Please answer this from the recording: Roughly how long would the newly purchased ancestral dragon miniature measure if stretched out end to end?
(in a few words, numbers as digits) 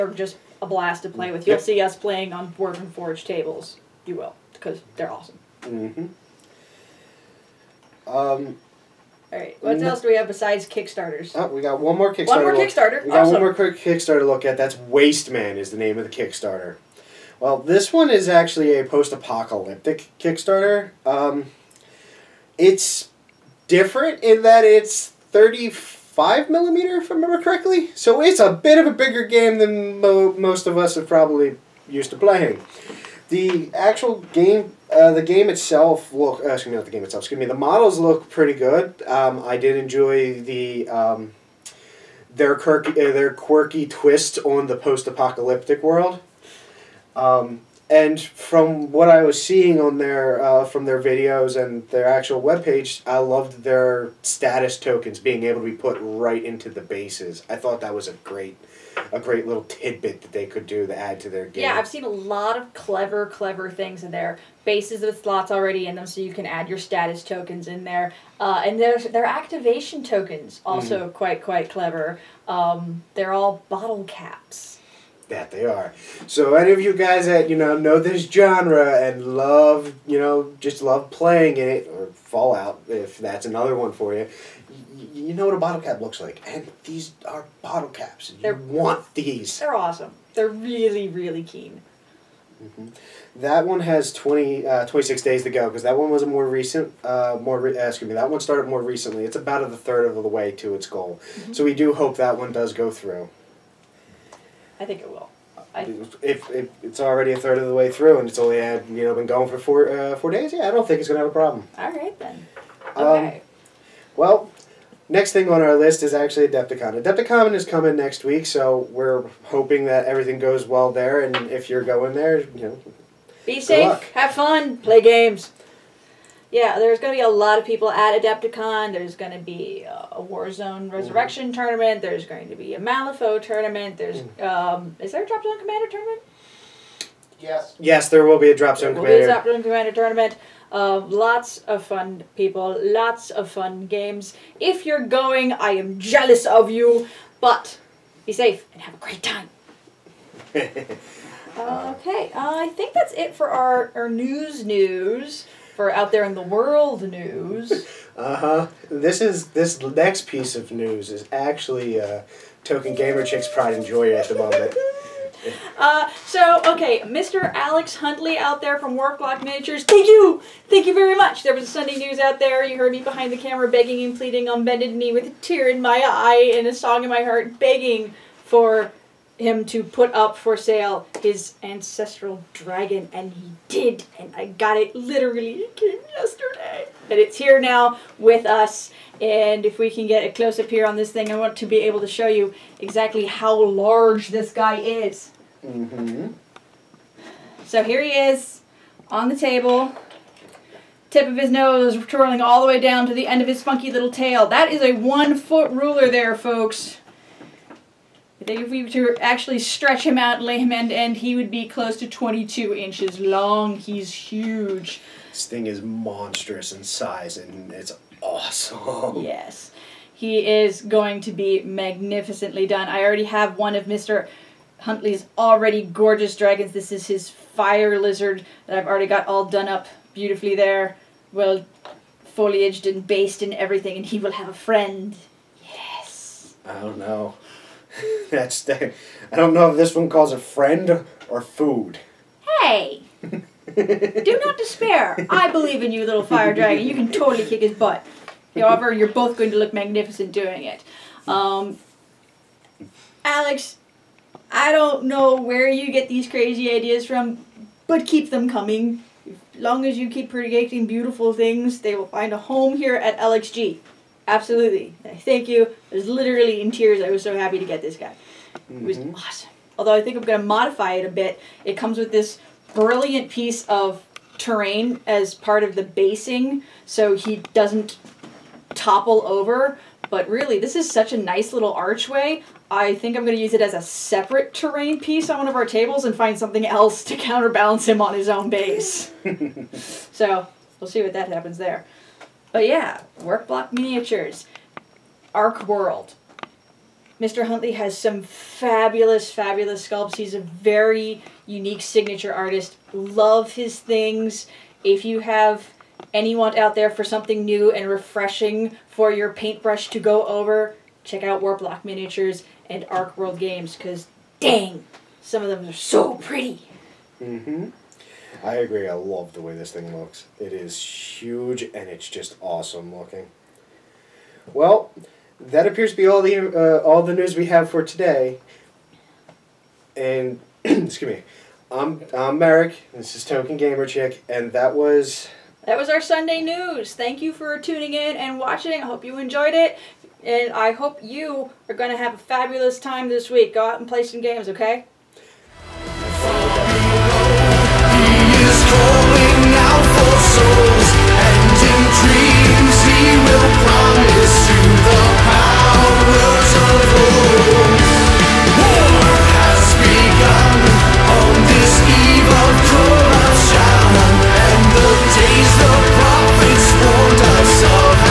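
22 inches.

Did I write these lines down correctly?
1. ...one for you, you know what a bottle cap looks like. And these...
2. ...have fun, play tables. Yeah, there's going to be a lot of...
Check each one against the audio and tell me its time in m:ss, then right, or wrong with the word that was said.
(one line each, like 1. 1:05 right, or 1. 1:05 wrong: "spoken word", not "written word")
1. 1:23 right
2. 2:04 wrong: "games", not "tables".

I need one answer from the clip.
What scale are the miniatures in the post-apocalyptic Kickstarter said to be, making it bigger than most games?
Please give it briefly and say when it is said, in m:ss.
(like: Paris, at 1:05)
35 millimeter, at 0:25.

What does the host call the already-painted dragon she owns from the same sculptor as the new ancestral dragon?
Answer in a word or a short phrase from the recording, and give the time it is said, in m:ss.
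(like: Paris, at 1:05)
fire lizard, at 3:47.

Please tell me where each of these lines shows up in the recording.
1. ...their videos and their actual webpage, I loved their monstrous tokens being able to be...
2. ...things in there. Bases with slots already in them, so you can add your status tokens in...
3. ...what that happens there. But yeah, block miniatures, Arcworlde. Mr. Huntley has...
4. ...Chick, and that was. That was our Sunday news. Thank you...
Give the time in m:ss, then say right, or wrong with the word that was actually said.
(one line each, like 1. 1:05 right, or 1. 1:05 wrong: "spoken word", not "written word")
1. 0:50 wrong: "status", not "monstrous"
2. 1:03 right
3. 4:51 right
4. 5:33 right.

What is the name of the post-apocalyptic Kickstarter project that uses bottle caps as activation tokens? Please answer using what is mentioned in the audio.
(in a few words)
Wasteman.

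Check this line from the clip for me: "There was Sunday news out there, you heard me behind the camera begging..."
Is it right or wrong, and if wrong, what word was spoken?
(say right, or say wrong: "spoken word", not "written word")
right.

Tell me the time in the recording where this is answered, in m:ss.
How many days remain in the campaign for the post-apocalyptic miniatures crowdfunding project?
1:34.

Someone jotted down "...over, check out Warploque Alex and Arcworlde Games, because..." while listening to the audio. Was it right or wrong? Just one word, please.
wrong.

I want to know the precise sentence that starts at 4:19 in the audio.
As long as you keep creating beautiful things, they will find a home here at LXG.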